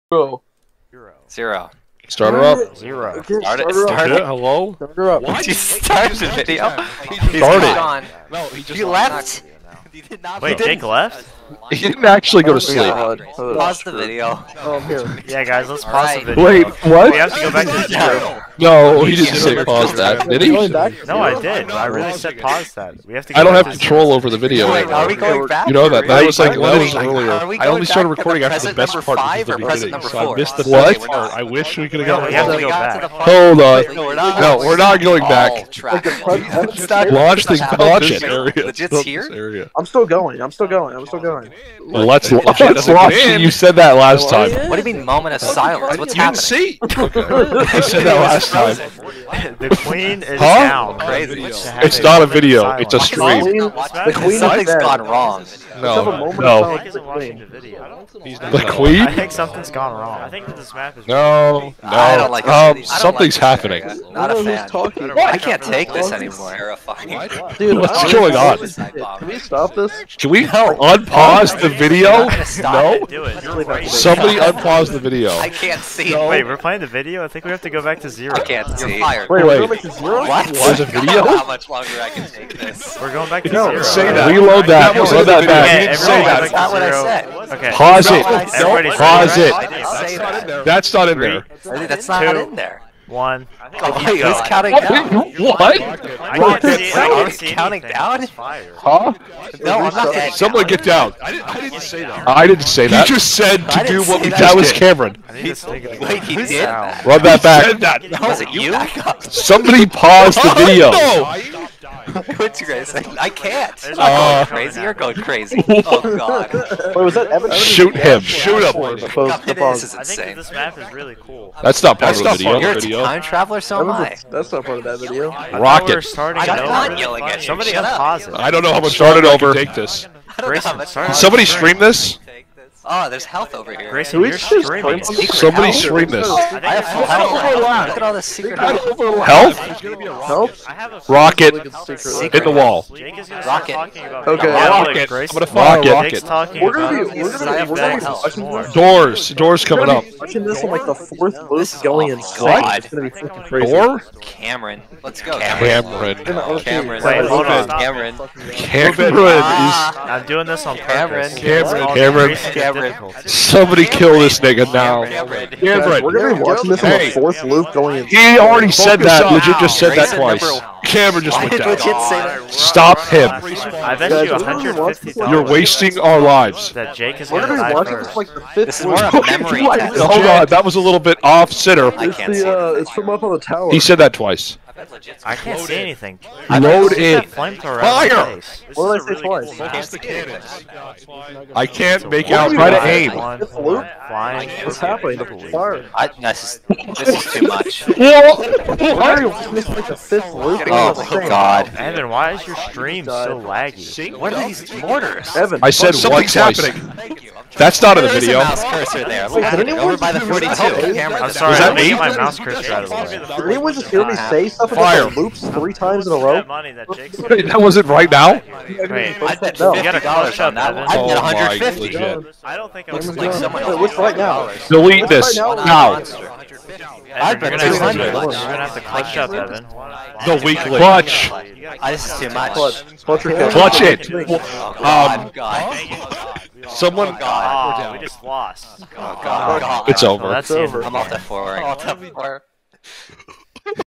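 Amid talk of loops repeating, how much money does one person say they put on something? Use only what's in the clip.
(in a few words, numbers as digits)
$50.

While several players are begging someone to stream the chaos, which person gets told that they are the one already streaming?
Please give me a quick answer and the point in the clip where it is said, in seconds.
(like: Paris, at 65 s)
Grayson, at 133 s.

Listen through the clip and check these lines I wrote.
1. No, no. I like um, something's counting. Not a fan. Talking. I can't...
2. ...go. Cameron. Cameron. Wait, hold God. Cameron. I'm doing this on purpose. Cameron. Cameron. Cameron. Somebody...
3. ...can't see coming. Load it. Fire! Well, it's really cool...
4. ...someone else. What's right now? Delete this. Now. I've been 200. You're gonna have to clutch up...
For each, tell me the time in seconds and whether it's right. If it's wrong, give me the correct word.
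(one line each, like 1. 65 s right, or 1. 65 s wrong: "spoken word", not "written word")
1. 61 s wrong: "happening", not "counting"
2. 155 s wrong: "Cameron", not "God"
3. 185 s wrong: "anything", not "coming"
4. 223 s right.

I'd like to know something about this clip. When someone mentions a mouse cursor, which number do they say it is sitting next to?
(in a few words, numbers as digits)
42.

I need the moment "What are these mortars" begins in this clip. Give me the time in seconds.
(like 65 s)
204 s.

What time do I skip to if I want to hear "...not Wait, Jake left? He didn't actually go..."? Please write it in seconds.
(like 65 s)
10 s.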